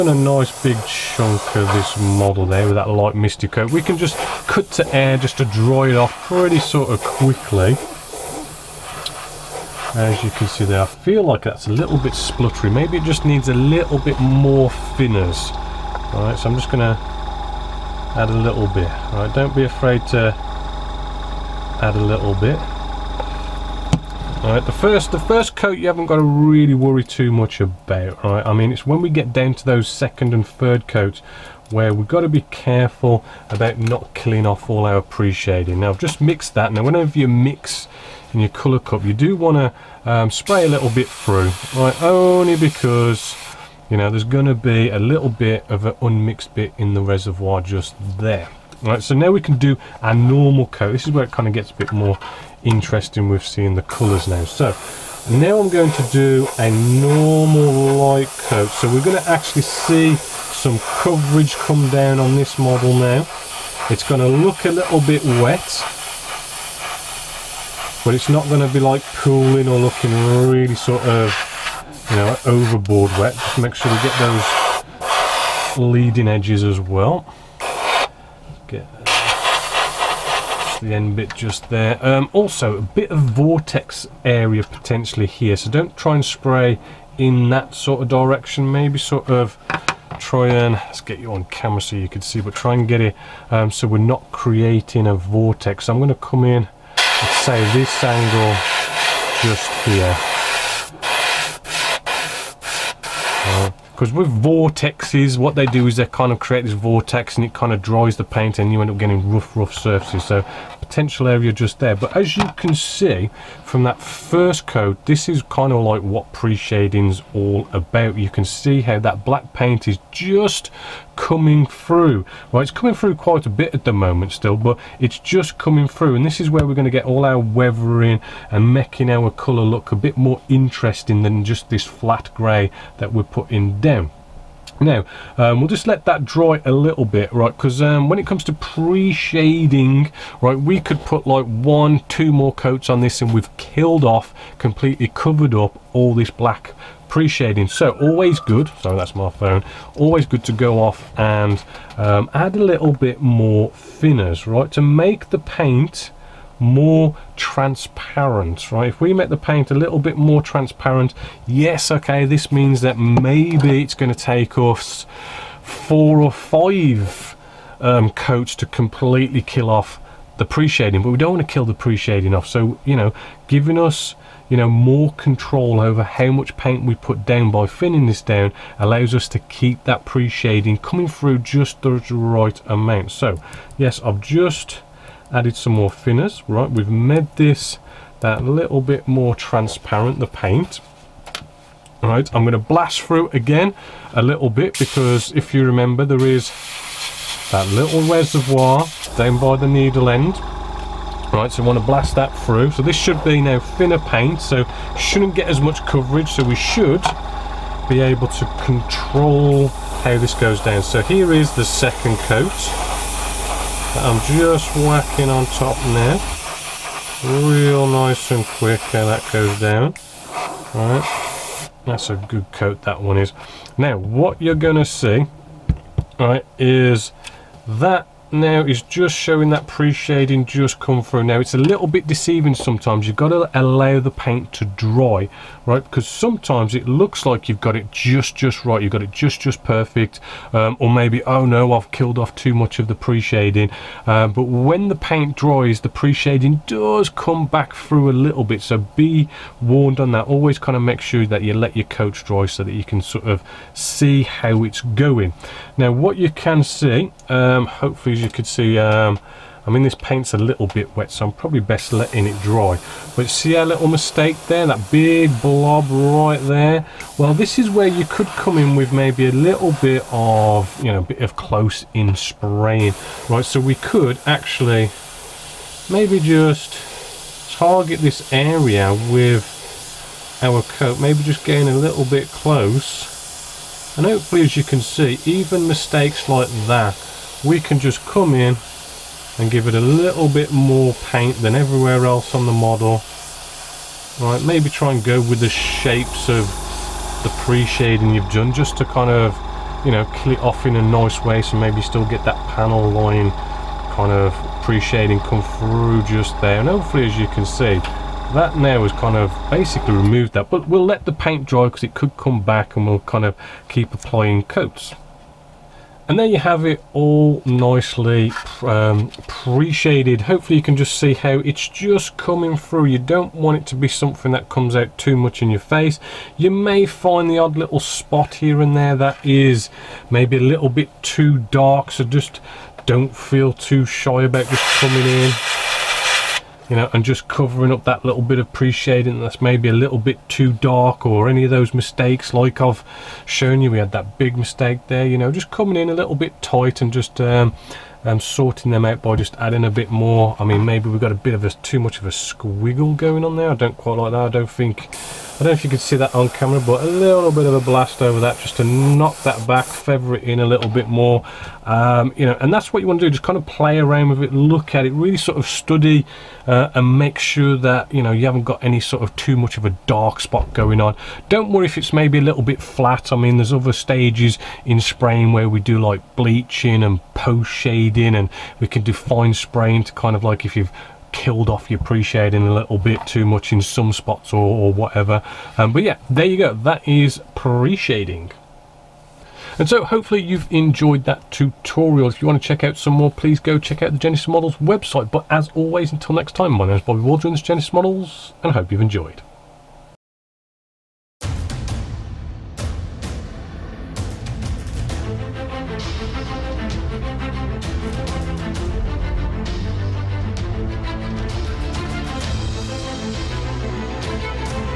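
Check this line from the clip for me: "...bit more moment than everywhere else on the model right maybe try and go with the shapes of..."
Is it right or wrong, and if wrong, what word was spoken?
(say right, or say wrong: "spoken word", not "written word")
wrong: "paint", not "moment".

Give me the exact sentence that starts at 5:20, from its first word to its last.
Hopefully you can just see how it's just coming through.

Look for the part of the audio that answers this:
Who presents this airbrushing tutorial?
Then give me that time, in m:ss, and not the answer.
6:36.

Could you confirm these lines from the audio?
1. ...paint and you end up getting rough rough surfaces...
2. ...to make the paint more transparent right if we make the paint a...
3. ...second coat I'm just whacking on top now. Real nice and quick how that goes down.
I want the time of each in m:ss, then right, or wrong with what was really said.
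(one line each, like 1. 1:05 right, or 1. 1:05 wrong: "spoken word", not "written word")
1. 1:48 right
2. 2:34 right
3. 3:31 right.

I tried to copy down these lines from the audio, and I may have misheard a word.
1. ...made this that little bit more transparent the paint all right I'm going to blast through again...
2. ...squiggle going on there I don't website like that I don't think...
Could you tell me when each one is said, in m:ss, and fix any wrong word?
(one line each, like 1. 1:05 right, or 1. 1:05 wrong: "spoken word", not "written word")
1. 3:06 right
2. 5:52 wrong: "quite", not "website".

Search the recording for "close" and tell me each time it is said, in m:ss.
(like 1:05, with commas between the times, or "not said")
4:31, 4:42.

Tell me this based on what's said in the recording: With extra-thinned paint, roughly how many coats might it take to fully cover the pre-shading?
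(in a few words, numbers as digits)
Four or five.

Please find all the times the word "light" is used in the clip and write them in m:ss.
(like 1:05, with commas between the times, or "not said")
0:02, 0:57.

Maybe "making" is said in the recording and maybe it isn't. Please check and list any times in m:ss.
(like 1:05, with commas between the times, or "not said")
2:08.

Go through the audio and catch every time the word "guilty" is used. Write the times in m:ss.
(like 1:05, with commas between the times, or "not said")
not said.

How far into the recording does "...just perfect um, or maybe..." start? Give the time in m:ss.
3:59.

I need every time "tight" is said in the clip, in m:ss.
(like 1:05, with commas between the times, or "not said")
5:46.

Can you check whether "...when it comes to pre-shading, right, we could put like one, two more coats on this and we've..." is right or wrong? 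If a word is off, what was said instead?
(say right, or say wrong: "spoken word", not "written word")
right.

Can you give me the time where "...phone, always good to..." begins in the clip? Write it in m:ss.
2:29.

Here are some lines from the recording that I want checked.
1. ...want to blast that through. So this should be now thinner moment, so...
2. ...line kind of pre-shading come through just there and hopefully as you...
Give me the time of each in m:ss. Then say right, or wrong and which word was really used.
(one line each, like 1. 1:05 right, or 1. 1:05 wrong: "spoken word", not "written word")
1. 3:21 wrong: "paint", not "moment"
2. 5:02 right.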